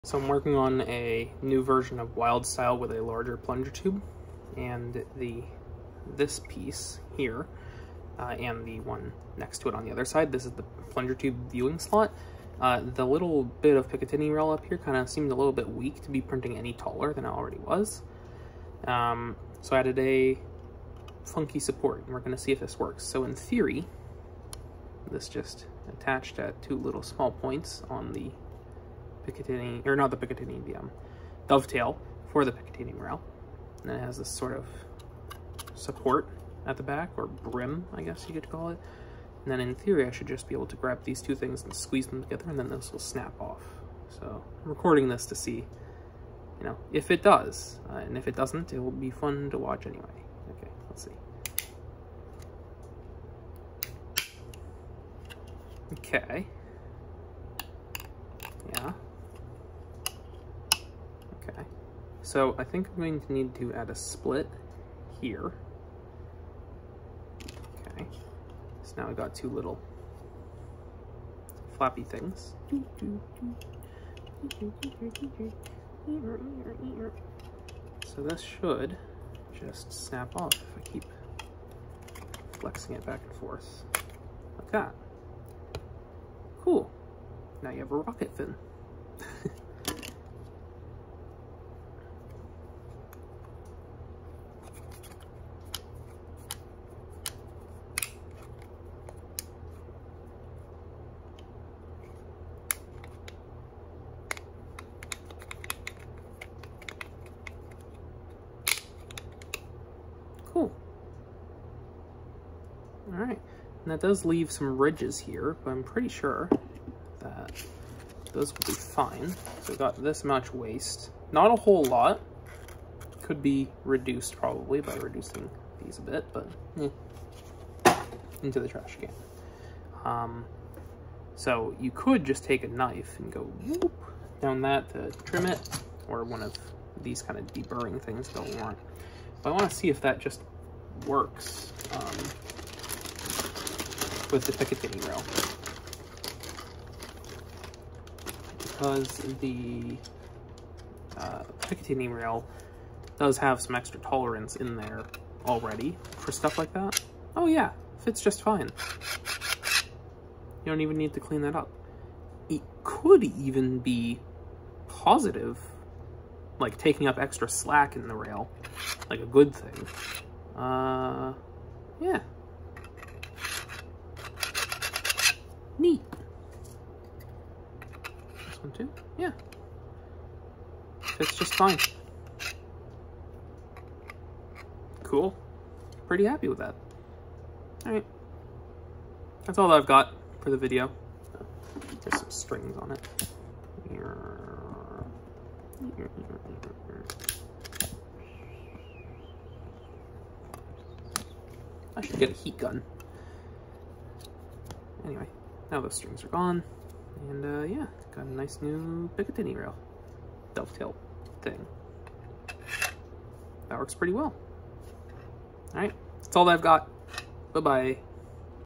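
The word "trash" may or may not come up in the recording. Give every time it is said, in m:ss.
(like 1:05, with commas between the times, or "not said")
2:08.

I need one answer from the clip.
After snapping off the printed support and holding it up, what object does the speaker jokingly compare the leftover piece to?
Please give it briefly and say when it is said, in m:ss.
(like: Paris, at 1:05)
rocket fin, at 1:27.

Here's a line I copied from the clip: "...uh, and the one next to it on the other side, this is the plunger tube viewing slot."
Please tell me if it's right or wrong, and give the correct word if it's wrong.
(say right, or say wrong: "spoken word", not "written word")
right.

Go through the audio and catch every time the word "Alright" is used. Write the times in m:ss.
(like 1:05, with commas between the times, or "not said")
3:07, 3:35.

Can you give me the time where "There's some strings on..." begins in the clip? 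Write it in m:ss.
3:12.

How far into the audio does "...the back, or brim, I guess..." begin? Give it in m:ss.
0:36.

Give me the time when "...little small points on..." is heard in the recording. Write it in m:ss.
0:26.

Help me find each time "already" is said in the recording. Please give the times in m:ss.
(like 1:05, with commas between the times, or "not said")
0:17, 2:35.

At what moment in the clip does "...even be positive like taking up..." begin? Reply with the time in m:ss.
2:43.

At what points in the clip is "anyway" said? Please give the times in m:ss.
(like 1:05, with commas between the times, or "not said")
0:49, 3:25.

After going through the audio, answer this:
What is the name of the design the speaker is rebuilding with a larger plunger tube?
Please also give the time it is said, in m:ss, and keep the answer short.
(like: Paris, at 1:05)
Wildstyle, at 0:02.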